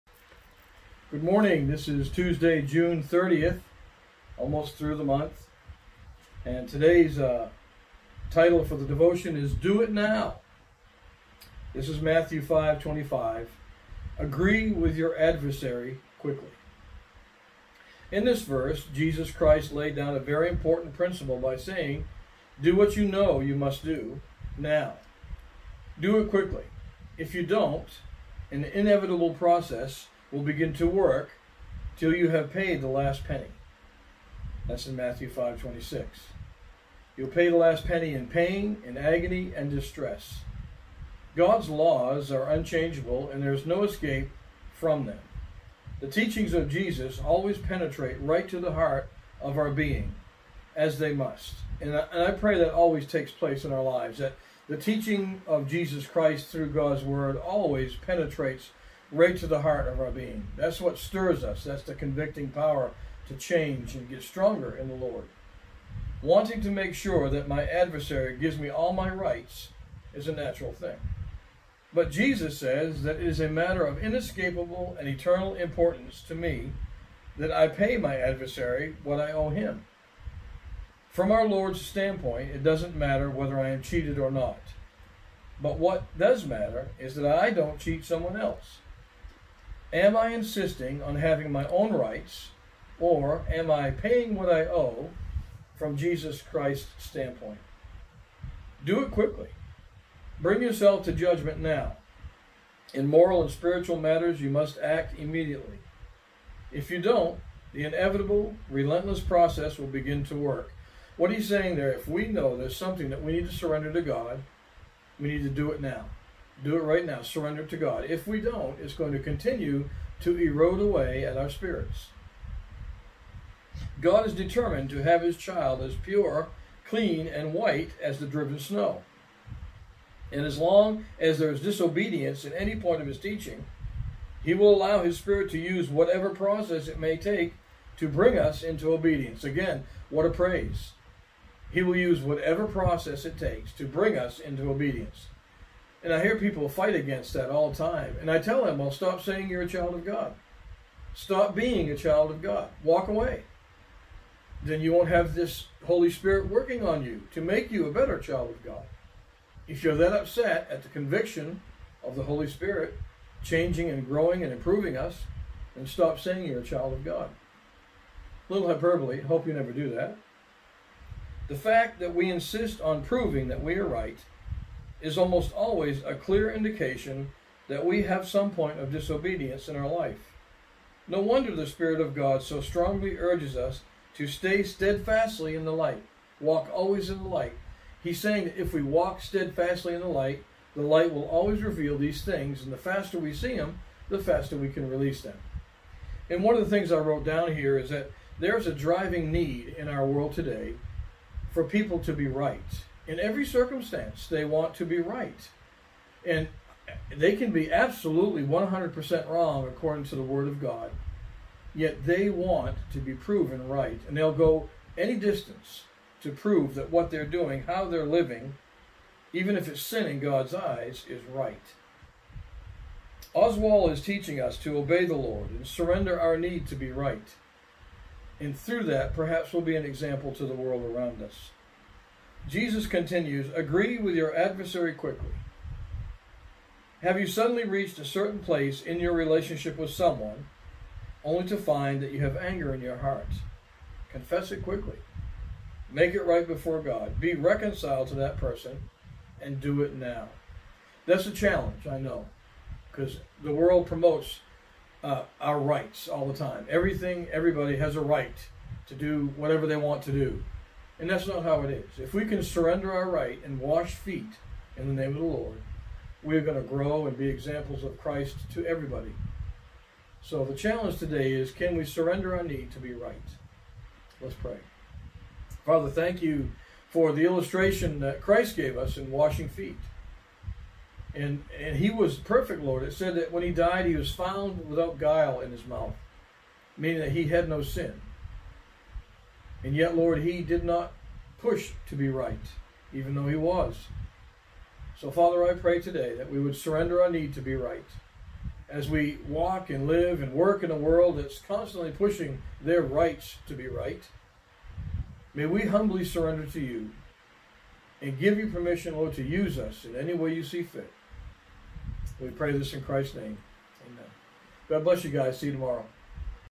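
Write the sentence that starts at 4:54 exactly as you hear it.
So, Father, I pray today that we would surrender our need to be right.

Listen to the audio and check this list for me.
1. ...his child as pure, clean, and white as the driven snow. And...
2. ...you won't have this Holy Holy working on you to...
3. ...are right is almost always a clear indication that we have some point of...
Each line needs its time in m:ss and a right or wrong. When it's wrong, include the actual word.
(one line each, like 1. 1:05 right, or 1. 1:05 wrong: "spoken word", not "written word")
1. 2:05 right
2. 2:34 wrong: "Spirit", not "Holy"
3. 2:53 right.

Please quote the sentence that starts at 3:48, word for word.
And through that, perhaps we'll be an example to the world around us.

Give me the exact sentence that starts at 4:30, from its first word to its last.
So the challenge today is can we surrender our need to be right?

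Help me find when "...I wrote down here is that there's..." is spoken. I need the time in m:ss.
3:16.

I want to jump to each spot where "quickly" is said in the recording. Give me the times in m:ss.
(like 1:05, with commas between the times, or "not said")
0:16, 0:26, 1:39, 3:54, 4:04.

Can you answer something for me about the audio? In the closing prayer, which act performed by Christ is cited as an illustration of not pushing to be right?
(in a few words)
washing feet.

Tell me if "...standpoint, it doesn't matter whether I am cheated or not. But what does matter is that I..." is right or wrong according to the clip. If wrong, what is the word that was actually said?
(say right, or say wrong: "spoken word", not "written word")
right.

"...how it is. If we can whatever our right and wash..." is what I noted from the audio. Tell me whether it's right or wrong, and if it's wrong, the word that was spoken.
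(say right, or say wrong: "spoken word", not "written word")
wrong: "surrender", not "whatever".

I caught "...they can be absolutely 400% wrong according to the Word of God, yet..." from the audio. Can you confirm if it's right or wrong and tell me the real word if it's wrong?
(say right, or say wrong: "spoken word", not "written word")
wrong: "100", not "400".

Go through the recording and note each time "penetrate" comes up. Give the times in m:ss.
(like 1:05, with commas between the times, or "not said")
0:47, 0:57.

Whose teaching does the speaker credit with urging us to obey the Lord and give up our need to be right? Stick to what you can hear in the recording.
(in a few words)
Oswald.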